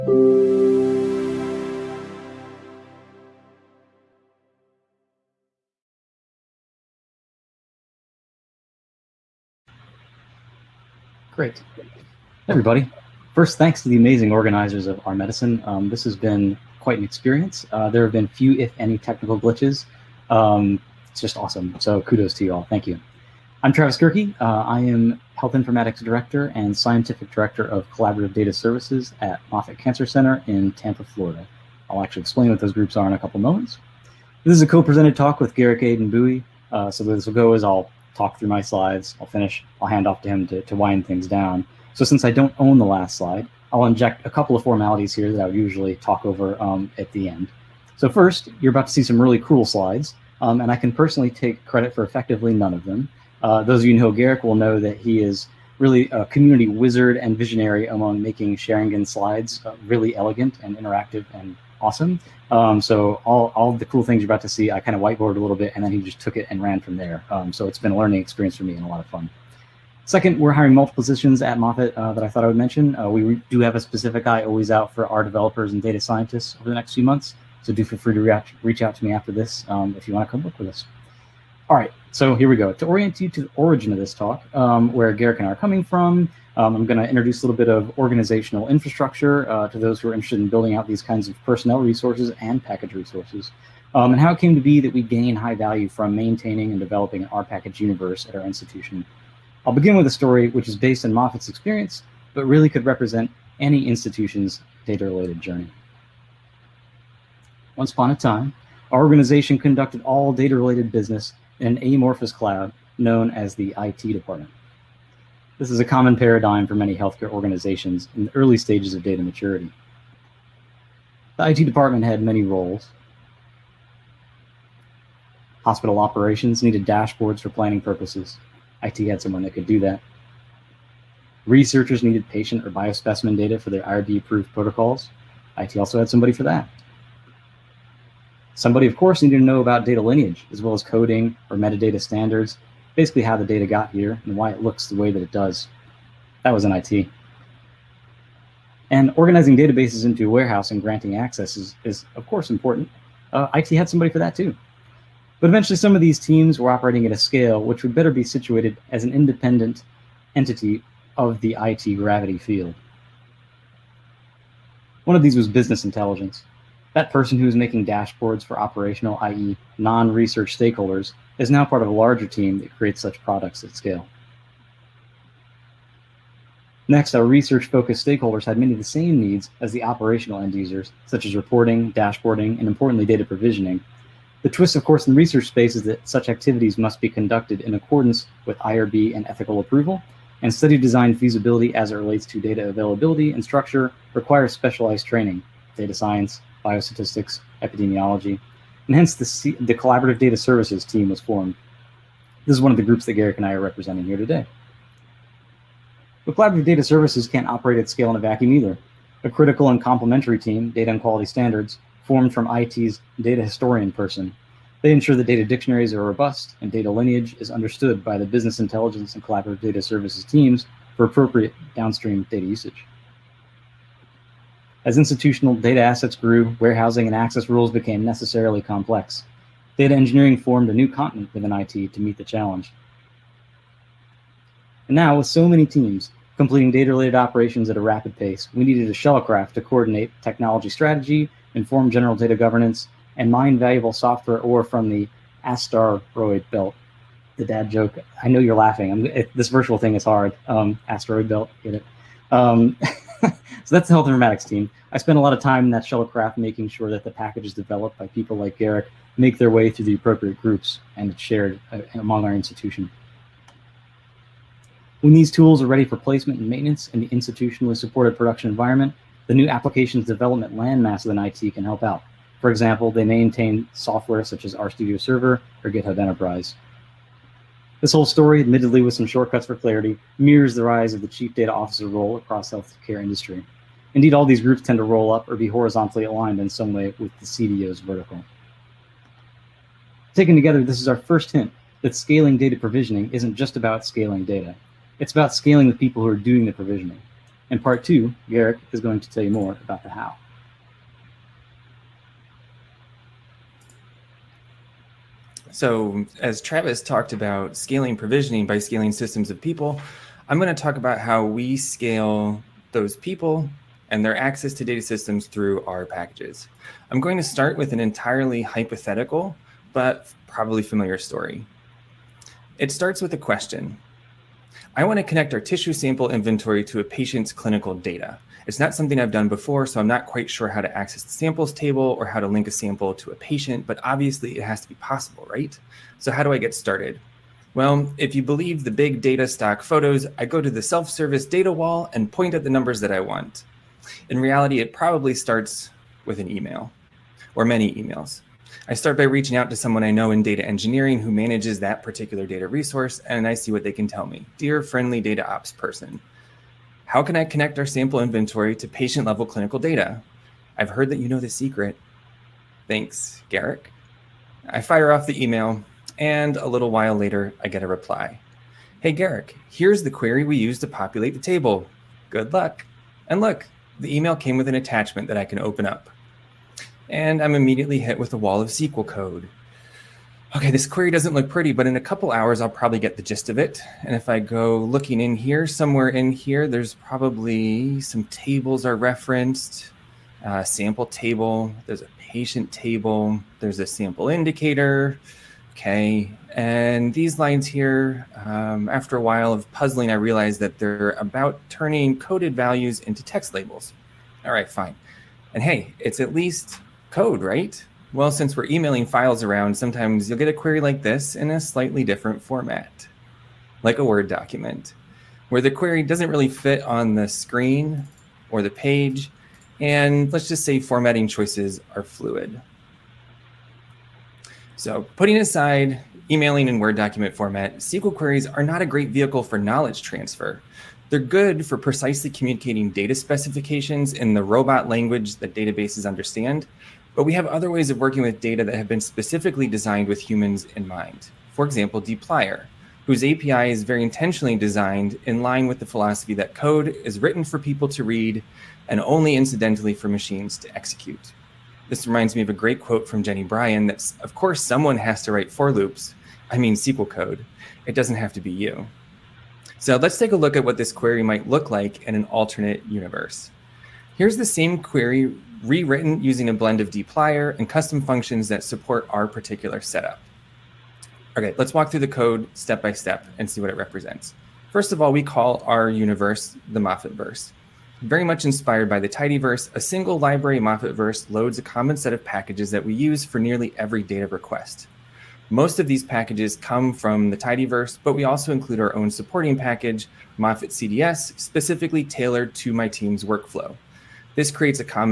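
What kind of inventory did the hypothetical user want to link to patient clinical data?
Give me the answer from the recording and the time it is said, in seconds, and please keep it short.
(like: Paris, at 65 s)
tissue sample inventory, at 325 s.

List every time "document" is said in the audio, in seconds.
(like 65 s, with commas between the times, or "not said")
414 s, 426 s.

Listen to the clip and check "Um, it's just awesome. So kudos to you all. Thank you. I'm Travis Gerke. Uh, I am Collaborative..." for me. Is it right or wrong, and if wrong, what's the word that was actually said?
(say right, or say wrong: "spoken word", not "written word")
wrong: "Health", not "Collaborative".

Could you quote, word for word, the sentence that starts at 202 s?
This is one of the groups that Garrick and I are representing here today.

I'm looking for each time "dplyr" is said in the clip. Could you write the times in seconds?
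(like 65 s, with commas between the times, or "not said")
441 s, 466 s.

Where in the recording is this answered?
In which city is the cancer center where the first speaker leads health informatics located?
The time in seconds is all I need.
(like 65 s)
30 s.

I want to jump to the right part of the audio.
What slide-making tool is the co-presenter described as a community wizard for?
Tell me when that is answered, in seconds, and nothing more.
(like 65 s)
58 s.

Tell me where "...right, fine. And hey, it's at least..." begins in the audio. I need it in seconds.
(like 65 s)
404 s.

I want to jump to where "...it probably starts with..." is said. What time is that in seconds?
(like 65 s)
344 s.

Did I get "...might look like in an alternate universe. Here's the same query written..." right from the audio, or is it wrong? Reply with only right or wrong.
wrong.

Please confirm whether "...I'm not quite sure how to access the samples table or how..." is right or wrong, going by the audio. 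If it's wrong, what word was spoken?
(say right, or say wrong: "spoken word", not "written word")
right.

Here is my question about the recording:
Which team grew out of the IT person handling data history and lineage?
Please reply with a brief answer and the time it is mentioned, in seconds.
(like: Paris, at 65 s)
data and quality standards, at 210 s.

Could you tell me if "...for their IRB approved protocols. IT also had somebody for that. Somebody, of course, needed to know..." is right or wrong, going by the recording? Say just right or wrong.
right.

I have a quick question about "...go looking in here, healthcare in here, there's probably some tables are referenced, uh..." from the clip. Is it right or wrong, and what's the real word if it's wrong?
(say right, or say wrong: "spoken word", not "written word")
wrong: "somewhere", not "healthcare".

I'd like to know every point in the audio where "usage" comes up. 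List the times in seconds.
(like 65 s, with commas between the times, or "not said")
222 s.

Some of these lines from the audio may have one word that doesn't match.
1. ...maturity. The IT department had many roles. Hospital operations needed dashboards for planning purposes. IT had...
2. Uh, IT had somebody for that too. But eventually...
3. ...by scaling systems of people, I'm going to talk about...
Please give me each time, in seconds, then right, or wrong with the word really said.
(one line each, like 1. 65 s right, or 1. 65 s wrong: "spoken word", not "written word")
1. 119 s right
2. 153 s right
3. 308 s right.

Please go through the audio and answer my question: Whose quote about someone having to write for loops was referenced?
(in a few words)
Jenny Bryan.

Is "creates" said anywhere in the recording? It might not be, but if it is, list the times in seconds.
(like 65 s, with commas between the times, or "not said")
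172 s, 494 s.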